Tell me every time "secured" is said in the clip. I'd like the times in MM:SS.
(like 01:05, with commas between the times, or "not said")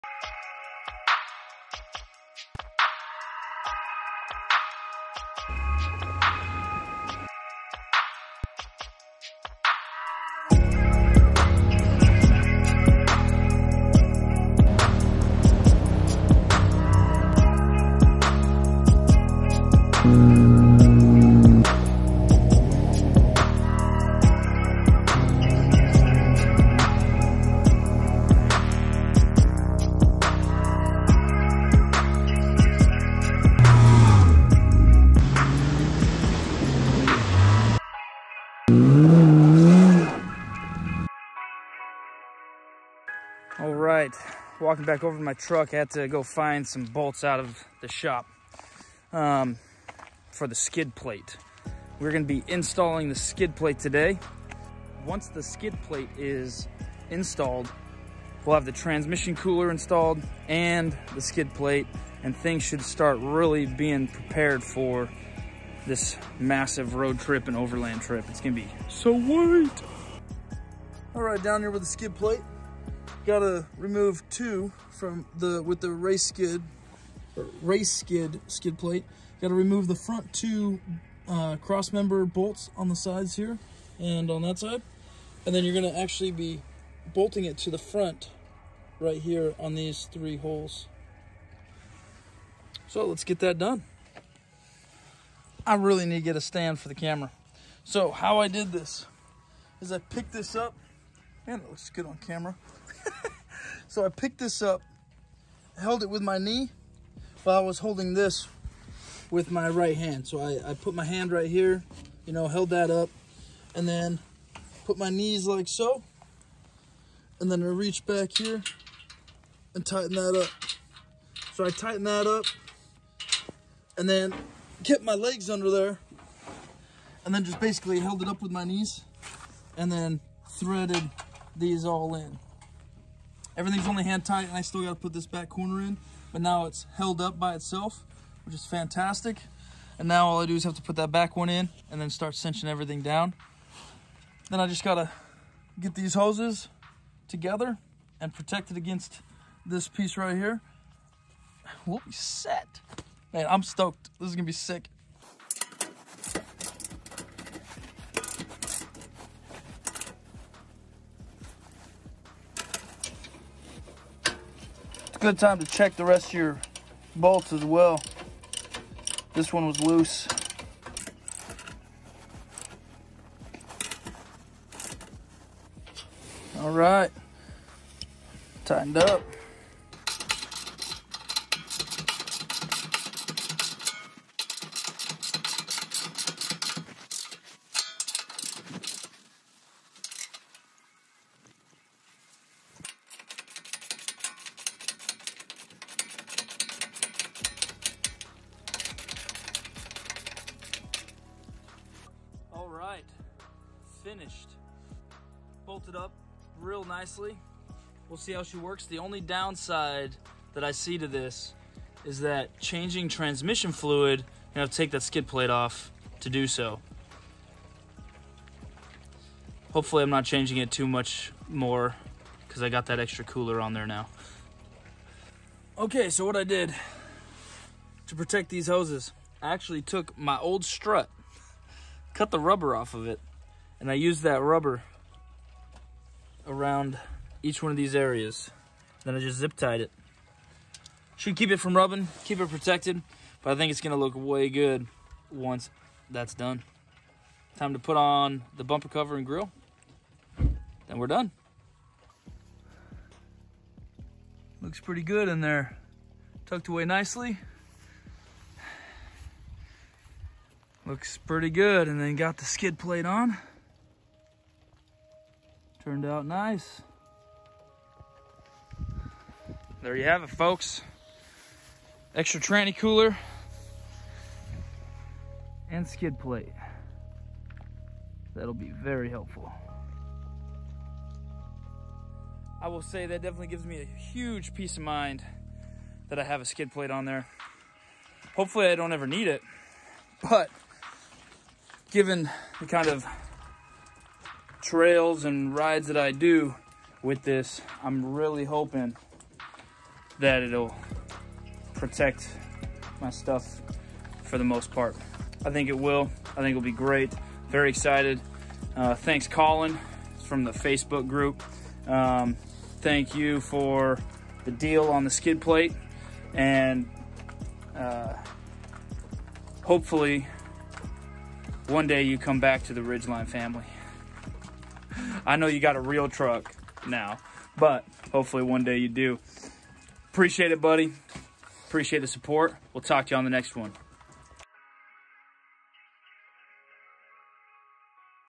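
not said.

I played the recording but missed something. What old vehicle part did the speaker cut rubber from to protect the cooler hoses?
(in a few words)
Strut.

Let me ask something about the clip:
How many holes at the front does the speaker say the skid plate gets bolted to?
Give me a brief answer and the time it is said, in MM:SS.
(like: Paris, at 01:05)
3, at 01:30.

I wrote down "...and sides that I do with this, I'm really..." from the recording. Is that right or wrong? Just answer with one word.
wrong.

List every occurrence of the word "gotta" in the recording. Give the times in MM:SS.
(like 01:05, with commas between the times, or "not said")
01:13, 01:19, 02:14, 02:24.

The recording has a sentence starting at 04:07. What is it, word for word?
Time to put on the bumper cover and grille.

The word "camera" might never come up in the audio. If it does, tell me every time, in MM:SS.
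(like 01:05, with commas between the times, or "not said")
01:36, 01:42.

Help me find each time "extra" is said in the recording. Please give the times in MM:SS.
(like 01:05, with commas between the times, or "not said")
03:42, 04:32.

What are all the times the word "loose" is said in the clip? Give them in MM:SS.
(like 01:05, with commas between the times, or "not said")
02:49.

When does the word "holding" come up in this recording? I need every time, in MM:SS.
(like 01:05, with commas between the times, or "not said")
01:47.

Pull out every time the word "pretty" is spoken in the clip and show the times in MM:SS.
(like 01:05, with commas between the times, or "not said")
04:14, 04:21.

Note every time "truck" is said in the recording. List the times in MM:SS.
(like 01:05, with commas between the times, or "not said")
00:45, 05:26.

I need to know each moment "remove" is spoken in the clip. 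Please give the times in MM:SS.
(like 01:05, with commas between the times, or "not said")
01:13, 01:19.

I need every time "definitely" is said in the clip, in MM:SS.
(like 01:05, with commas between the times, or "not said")
04:43.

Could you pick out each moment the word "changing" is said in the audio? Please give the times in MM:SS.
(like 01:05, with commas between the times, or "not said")
03:32, 03:40.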